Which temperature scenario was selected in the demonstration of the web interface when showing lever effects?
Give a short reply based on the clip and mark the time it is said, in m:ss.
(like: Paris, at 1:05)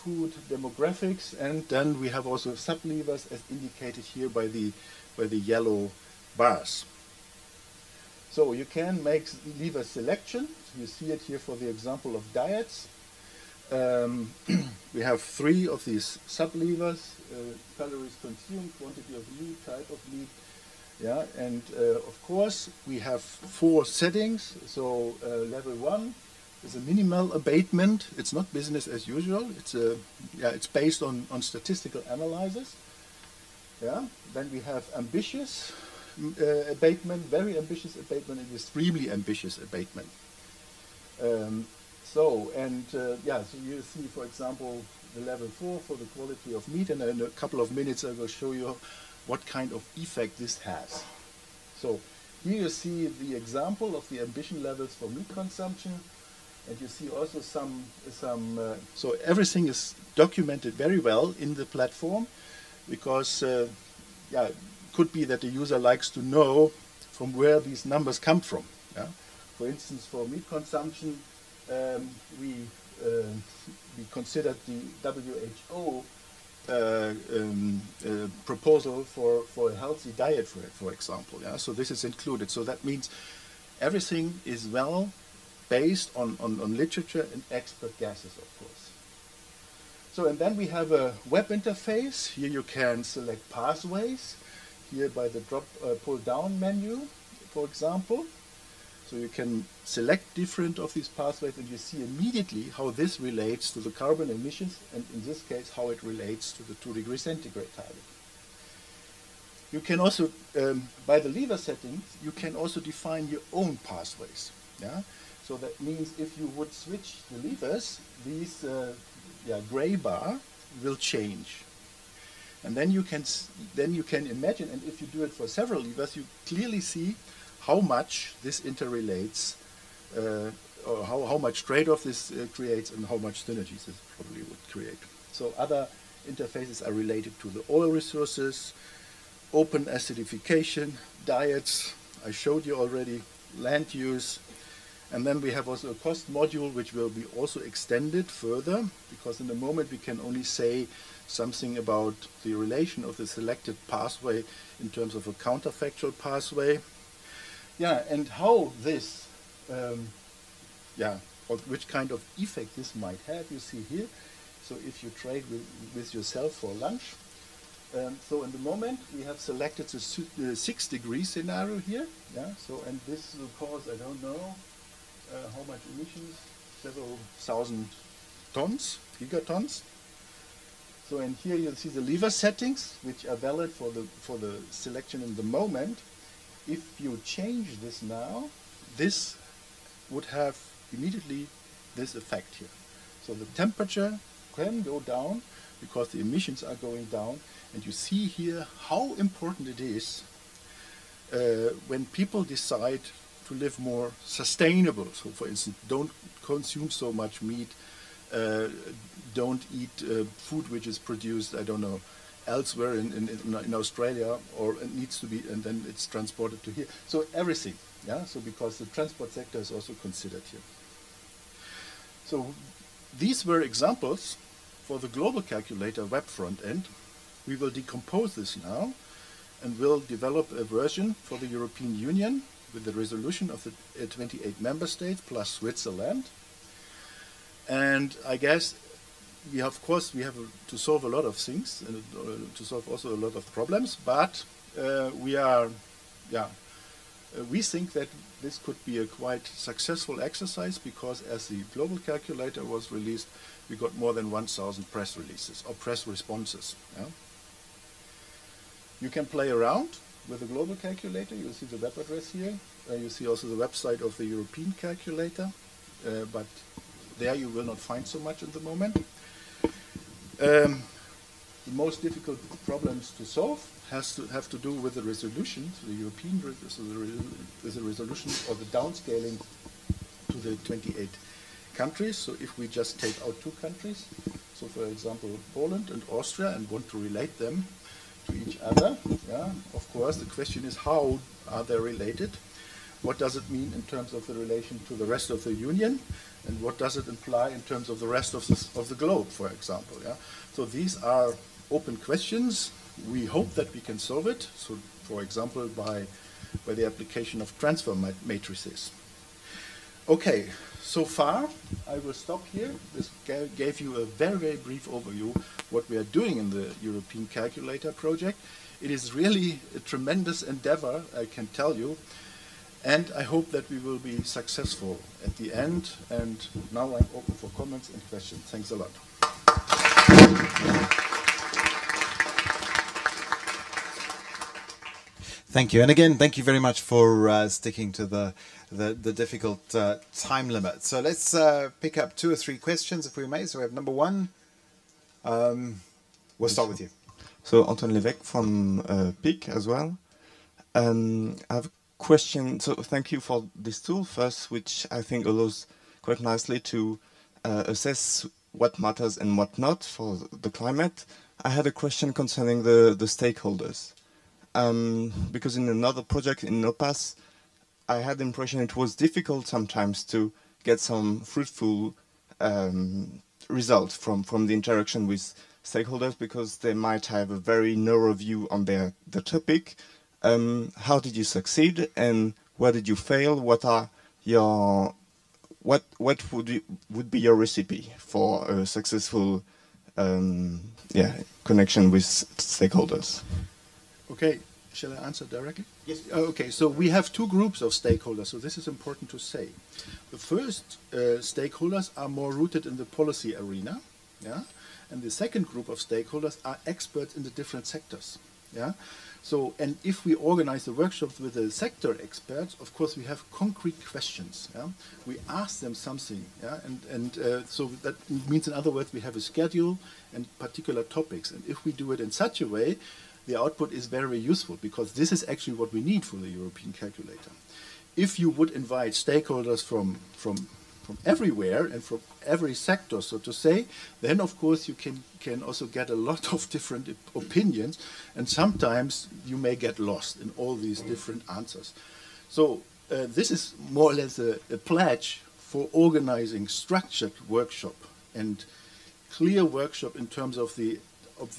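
6 degree scenario, at 2:50.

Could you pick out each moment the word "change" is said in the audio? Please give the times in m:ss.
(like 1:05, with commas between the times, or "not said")
2:00, 3:07.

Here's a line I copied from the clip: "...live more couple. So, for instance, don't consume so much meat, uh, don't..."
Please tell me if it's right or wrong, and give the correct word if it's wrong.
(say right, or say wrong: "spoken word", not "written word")
wrong: "sustainable", not "couple".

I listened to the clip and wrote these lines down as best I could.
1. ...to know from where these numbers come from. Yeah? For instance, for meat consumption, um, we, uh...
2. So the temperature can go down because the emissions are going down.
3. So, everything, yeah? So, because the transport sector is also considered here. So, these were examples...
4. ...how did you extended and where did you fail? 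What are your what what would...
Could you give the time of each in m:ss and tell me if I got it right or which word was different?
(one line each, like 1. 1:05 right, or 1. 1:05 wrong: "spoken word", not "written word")
1. 1:06 right
2. 3:13 right
3. 3:37 right
4. 6:20 wrong: "succeed", not "extended".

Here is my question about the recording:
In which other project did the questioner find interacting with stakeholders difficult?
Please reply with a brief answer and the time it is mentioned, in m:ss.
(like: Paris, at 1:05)
INNOPATHS, at 6:06.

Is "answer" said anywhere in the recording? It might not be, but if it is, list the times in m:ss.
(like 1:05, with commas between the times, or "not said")
6:35, 7:21.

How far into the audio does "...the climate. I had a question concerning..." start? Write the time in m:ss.
6:00.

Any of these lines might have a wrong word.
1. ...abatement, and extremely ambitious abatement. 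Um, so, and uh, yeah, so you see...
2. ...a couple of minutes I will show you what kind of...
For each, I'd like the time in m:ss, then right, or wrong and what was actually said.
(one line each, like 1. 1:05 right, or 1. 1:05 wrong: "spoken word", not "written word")
1. 0:37 right
2. 0:47 right.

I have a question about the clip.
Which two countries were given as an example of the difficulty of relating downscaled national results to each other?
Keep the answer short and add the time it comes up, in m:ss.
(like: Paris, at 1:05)
Poland and Austria, at 4:45.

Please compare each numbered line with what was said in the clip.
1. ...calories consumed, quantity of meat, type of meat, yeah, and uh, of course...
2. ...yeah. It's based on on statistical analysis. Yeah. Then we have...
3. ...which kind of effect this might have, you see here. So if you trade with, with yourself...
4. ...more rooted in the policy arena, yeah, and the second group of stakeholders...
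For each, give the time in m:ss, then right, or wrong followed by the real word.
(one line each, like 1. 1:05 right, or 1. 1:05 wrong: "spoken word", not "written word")
1. 0:17 right
2. 0:30 right
3. 2:41 right
4. 6:42 right.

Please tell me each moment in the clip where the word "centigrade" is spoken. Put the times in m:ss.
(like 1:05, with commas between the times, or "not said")
1:47.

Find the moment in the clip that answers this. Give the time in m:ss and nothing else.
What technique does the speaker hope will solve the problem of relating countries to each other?
5:07.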